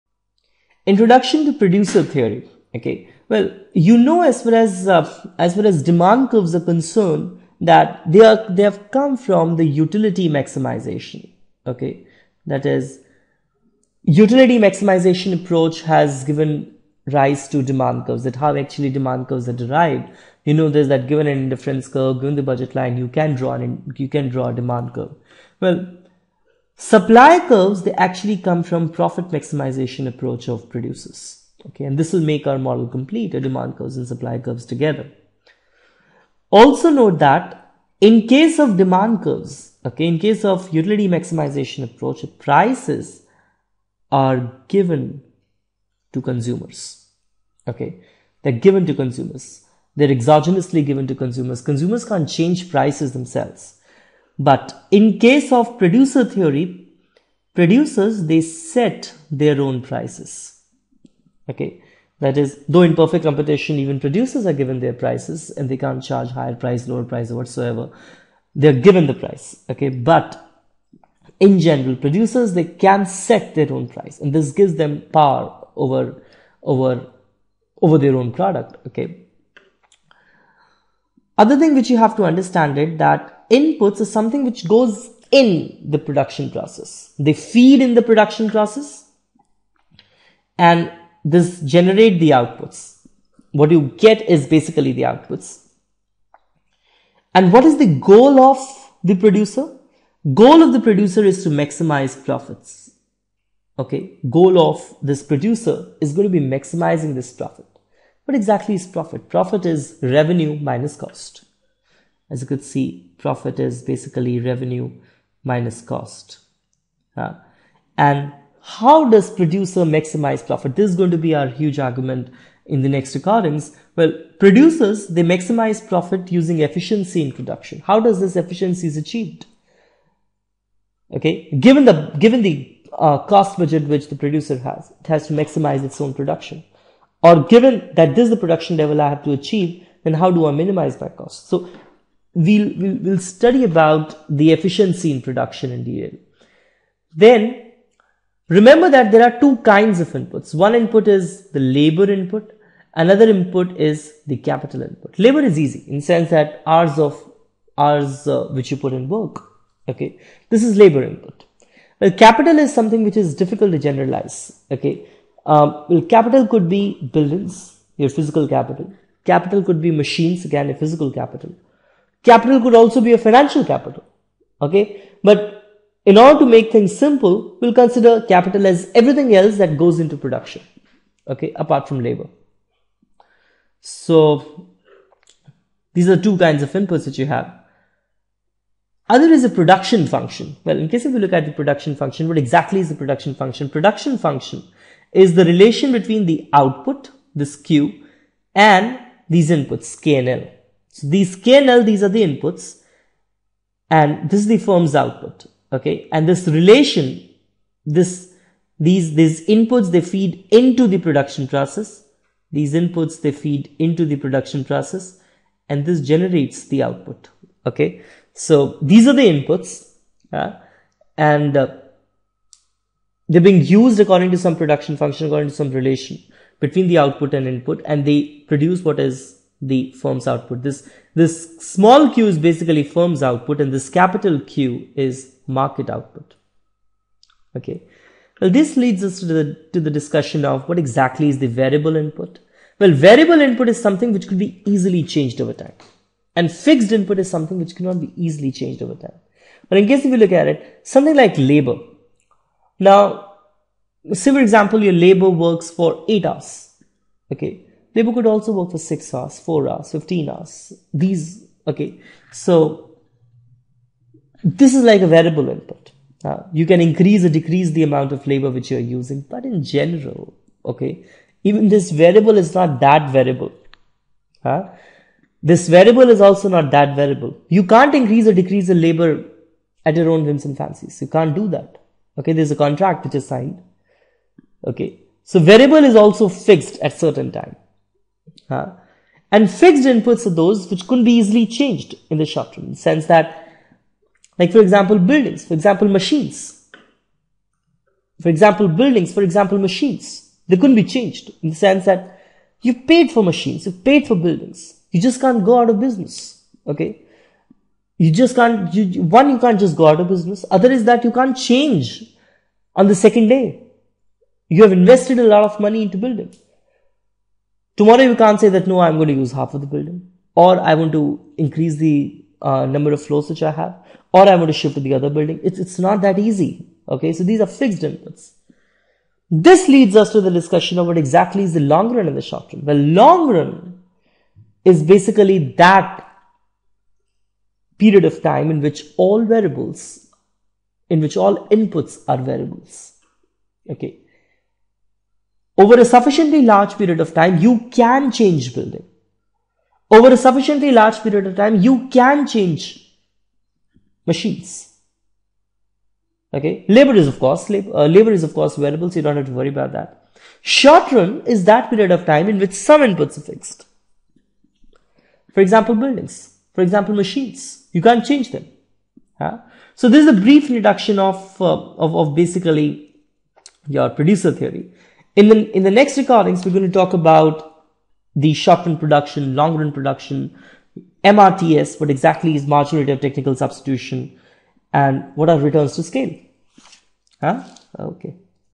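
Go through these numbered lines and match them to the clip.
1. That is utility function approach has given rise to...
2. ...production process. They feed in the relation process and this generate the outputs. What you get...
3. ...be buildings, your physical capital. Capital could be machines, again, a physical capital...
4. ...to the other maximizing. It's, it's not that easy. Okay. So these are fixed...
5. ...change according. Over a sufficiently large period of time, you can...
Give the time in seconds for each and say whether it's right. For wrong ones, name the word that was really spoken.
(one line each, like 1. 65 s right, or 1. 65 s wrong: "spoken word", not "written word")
1. 12 s wrong: "maximization", not "function"
2. 85 s wrong: "production", not "relation"
3. 166 s right
4. 324 s wrong: "building", not "maximizing"
5. 348 s wrong: "building", not "according".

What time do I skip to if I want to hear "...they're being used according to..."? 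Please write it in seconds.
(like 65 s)
223 s.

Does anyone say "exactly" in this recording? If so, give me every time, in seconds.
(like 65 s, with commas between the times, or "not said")
108 s, 192 s, 240 s, 330 s, 381 s.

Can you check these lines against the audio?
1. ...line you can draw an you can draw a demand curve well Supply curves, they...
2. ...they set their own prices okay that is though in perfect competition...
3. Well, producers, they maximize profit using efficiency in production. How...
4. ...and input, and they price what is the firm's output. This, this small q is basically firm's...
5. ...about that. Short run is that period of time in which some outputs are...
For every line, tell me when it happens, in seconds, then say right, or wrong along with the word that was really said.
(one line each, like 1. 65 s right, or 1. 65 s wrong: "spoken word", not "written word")
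1. 22 s right
2. 58 s right
3. 123 s right
4. 227 s wrong: "produce", not "price"
5. 359 s wrong: "inputs", not "outputs".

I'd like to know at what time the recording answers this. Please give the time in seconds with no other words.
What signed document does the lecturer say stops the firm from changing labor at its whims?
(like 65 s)
282 s.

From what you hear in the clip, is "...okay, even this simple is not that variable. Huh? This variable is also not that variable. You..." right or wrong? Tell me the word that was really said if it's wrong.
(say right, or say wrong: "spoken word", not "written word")
wrong: "variable", not "simple".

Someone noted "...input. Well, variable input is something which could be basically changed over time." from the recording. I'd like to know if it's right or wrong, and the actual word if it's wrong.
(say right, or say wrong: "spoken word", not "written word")
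wrong: "easily", not "basically".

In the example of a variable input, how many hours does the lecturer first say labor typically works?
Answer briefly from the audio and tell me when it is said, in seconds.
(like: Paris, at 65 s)
8 hours, at 256 s.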